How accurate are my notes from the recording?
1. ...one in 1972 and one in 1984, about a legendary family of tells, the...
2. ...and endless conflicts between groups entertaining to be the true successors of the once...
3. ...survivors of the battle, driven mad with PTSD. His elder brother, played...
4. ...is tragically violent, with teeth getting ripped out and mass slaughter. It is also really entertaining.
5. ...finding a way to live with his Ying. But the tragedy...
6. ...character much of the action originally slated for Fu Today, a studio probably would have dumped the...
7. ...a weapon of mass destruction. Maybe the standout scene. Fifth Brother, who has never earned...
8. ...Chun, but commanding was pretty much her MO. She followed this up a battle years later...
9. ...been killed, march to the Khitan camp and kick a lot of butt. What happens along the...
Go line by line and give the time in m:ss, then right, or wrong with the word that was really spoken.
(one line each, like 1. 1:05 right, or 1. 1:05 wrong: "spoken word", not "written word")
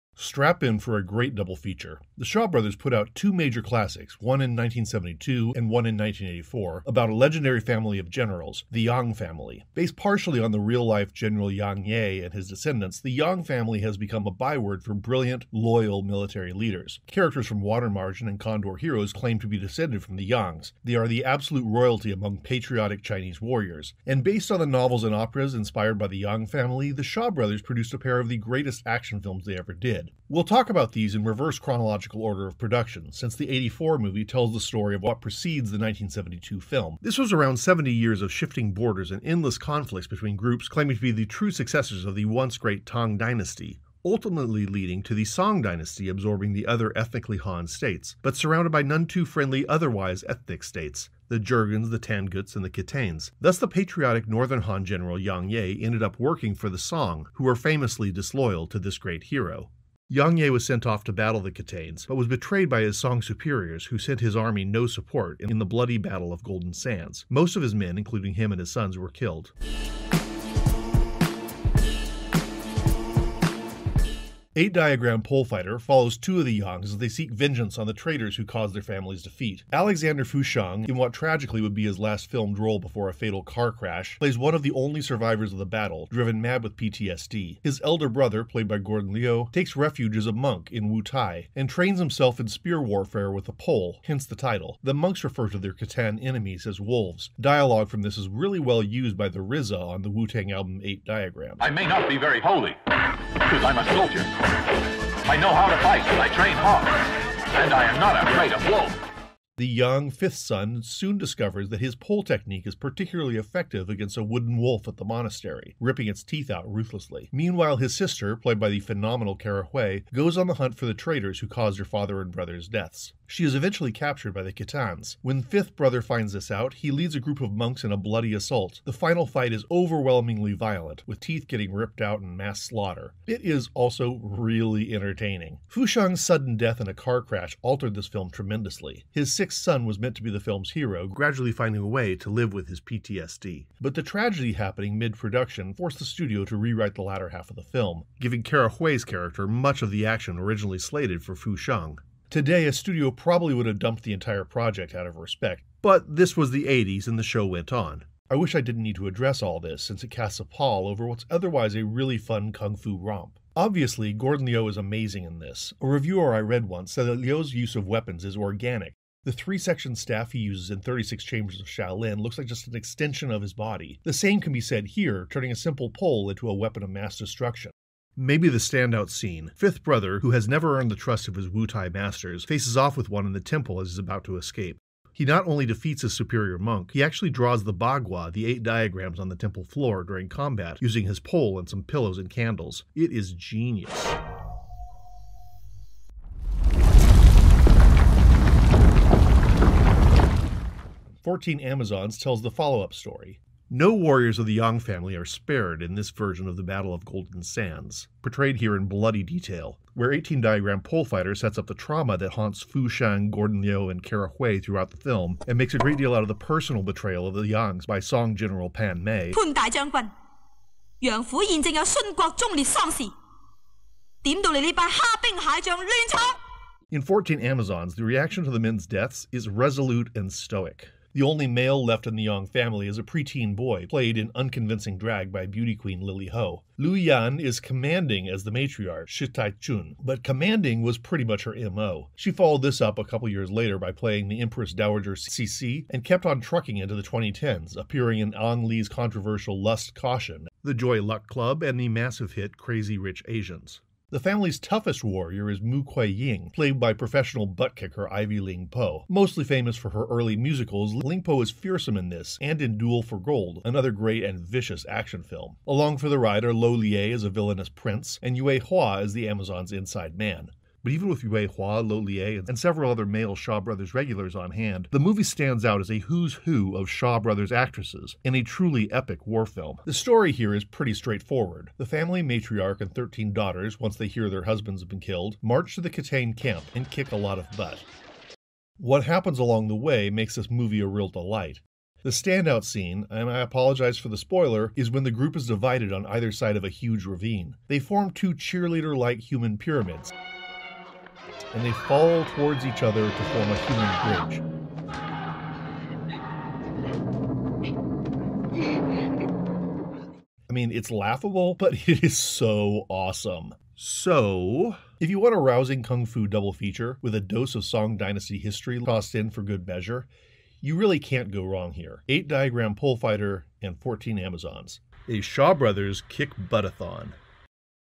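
1. 0:04 wrong: "generals", not "tells"
2. 0:39 wrong: "claiming", not "entertaining"
3. 1:25 right
4. 2:09 wrong: "overwhelmingly", not "tragically"
5. 2:21 wrong: "PTSD", not "Ying"
6. 2:29 right
7. 2:56 right
8. 3:59 wrong: "couple", not "battle"
9. 4:44 right.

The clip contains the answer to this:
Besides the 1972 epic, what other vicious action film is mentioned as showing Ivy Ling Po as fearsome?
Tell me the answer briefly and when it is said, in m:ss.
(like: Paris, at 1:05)
Duel for Gold, at 4:22.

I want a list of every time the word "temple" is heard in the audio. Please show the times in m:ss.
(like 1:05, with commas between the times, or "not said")
3:03, 3:09.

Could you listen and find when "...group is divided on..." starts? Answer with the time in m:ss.
4:55.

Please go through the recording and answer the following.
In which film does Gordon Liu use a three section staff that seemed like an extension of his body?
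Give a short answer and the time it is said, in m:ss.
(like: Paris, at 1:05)
36 Chambers of Shaolin, at 2:50.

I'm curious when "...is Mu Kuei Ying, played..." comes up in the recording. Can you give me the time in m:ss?
4:15.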